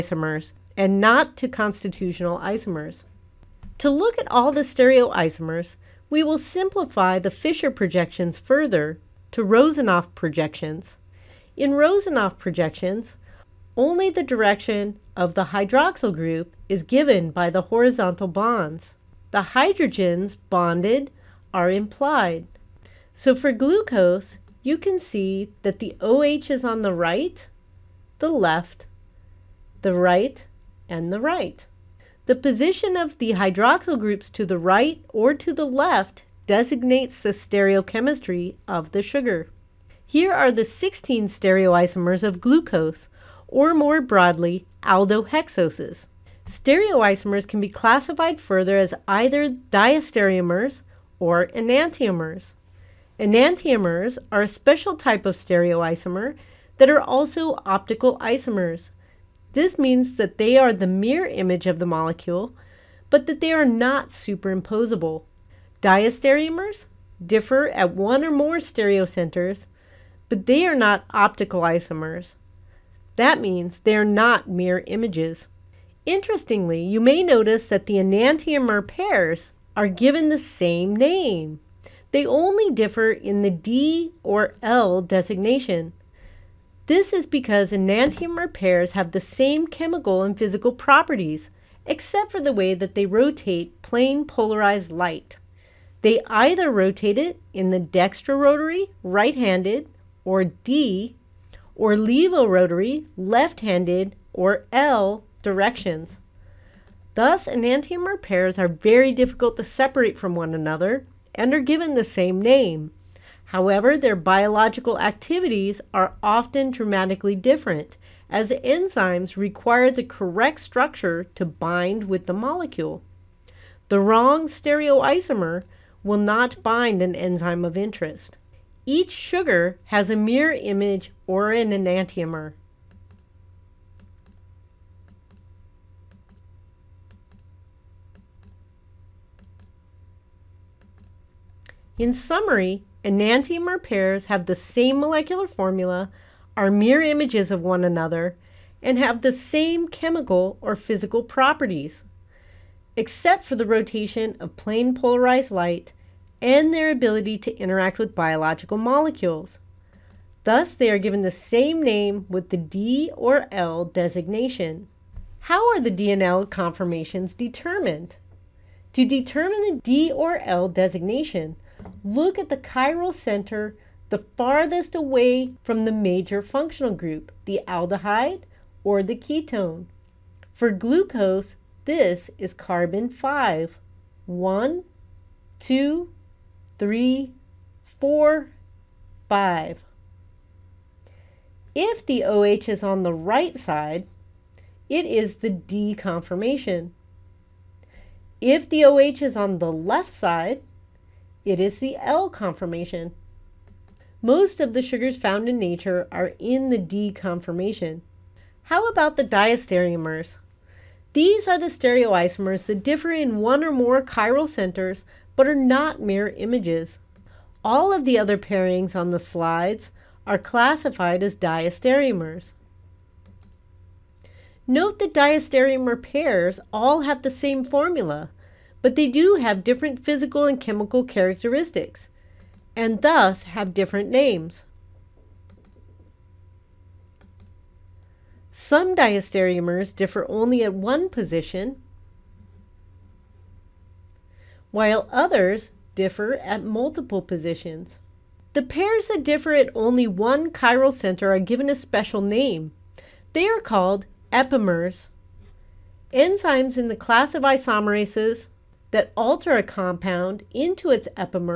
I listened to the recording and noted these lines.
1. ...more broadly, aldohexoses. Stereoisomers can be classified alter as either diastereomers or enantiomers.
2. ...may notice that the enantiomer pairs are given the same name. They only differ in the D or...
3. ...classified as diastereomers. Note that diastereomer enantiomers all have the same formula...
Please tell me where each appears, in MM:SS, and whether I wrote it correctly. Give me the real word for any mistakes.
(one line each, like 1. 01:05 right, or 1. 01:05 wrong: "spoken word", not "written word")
1. 00:43 wrong: "further", not "alter"
2. 01:17 right
3. 03:40 wrong: "pairs", not "enantiomers".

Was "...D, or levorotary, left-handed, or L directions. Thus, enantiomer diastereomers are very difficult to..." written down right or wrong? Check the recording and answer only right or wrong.
wrong.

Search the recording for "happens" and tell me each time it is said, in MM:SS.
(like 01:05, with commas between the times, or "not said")
not said.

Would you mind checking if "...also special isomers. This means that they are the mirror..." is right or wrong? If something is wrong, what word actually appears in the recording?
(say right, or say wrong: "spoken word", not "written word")
wrong: "optical", not "special".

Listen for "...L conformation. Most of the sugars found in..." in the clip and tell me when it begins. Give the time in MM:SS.
03:21.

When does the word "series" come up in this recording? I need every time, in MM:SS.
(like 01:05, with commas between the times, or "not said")
not said.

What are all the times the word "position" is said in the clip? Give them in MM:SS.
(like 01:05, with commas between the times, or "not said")
00:32, 04:01, 04:07.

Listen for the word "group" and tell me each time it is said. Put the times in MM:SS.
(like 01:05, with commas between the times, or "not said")
00:16, 00:33, 02:56.